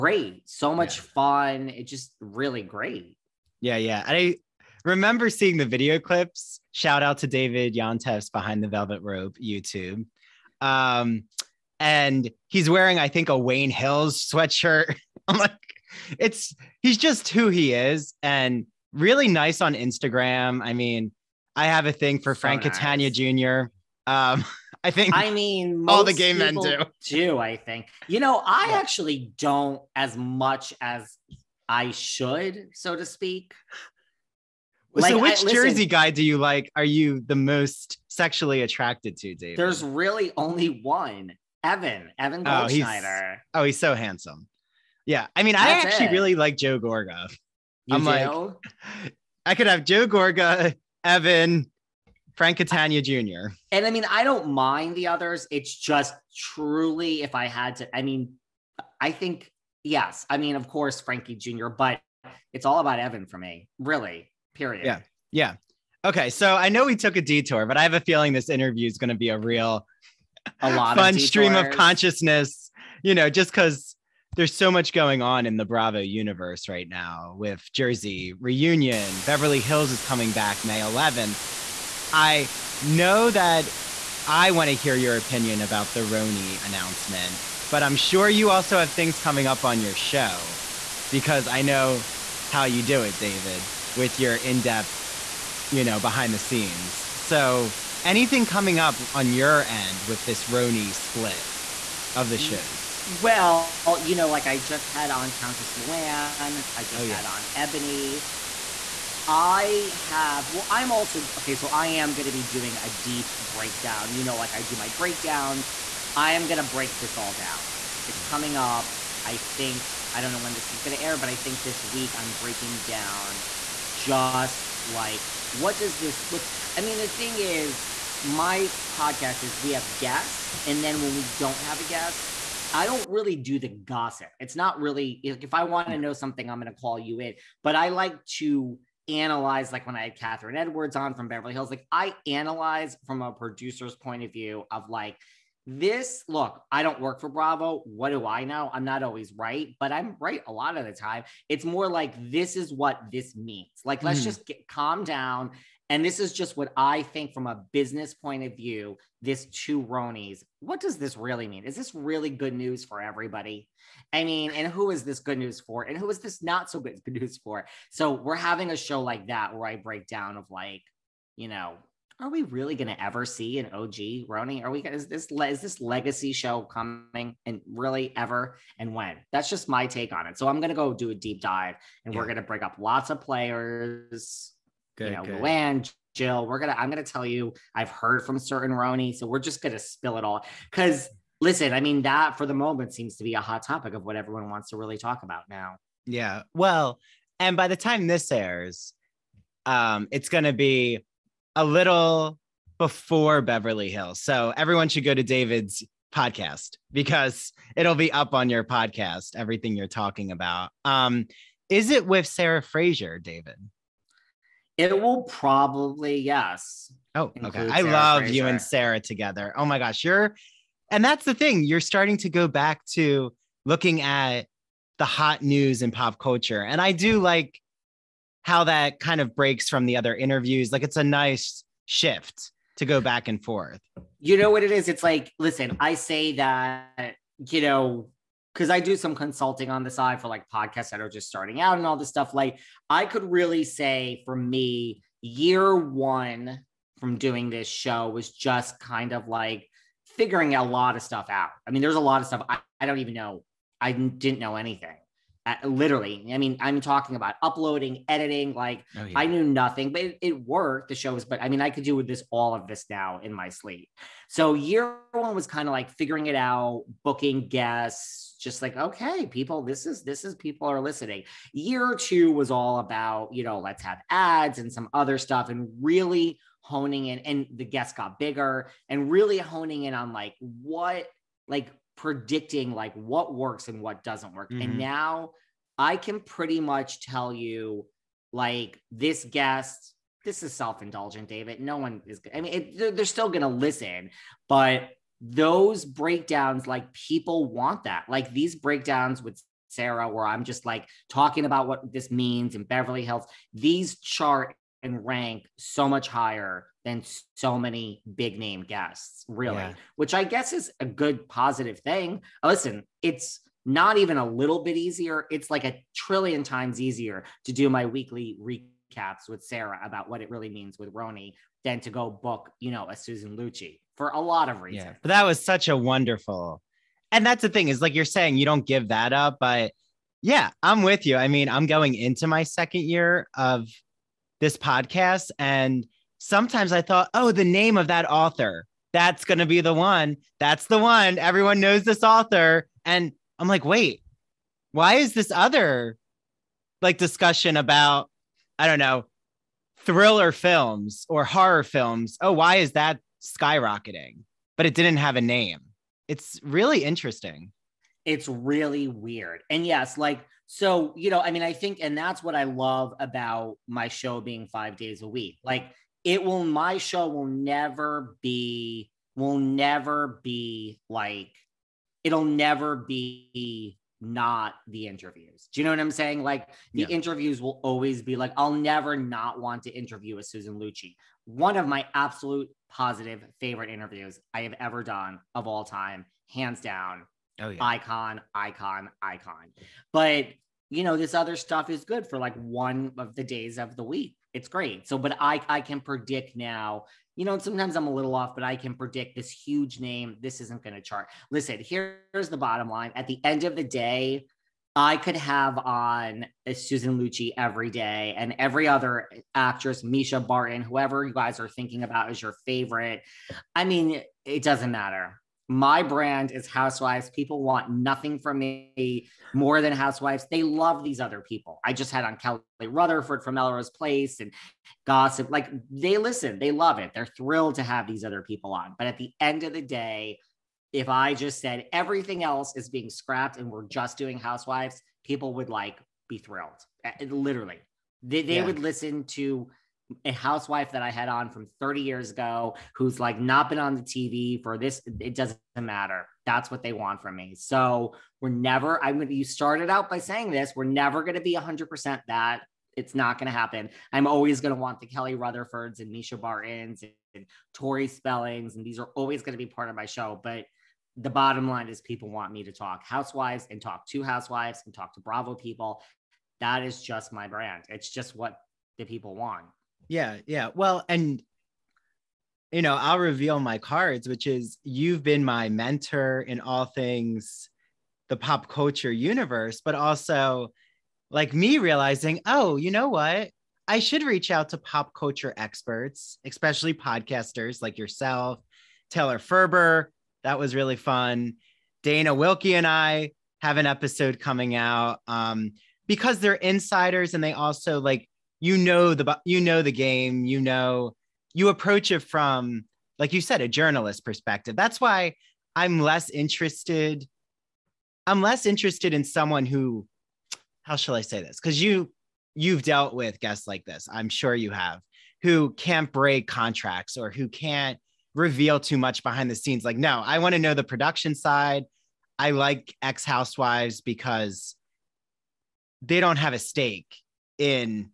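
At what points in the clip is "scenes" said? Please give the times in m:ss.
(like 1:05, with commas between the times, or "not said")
1:36, 8:39.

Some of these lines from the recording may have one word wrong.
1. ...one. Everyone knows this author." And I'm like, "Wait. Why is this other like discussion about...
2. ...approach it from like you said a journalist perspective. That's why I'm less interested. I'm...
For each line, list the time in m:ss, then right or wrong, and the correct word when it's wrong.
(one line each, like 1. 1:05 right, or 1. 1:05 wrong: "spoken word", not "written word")
1. 5:40 right
2. 8:21 right.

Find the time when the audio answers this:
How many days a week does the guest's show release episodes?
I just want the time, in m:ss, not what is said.
6:04.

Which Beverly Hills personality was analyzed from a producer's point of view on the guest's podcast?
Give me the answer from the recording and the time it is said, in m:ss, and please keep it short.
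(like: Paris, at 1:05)
Kathryn Edwards, at 2:20.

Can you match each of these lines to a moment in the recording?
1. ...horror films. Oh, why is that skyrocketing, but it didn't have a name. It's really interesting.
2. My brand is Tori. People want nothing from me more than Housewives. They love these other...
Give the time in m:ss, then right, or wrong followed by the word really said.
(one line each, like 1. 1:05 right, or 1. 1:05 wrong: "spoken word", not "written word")
1. 5:51 right
2. 6:55 wrong: "Housewives", not "Tori".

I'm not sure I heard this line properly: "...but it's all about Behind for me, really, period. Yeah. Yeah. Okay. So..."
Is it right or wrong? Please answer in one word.
wrong.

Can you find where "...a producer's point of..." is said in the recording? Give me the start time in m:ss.
2:23.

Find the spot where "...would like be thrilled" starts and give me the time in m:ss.
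7:15.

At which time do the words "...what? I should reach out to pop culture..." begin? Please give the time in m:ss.
8:02.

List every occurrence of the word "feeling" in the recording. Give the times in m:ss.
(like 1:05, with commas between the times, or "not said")
1:07.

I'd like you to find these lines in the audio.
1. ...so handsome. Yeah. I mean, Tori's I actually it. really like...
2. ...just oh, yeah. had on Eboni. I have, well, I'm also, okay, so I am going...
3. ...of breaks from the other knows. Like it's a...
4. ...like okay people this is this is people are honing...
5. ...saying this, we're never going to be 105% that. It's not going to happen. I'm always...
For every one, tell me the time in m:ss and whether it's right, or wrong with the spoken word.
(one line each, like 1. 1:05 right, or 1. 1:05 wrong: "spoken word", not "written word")
1. 0:43 wrong: "That", not "Tori"
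2. 1:46 right
3. 3:49 wrong: "interviews", not "knows"
4. 4:28 wrong: "listening", not "honing"
5. 7:29 wrong: "100", not "105".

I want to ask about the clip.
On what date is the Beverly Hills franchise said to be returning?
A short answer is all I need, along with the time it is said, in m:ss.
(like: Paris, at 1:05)
May 11th, at 1:20.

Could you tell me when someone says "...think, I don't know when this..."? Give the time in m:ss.
1:59.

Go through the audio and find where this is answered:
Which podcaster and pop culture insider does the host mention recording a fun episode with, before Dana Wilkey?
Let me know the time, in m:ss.
8:08.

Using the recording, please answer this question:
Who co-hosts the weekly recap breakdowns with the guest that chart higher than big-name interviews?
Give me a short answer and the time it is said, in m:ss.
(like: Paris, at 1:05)
Sarah Fraser, at 3:32.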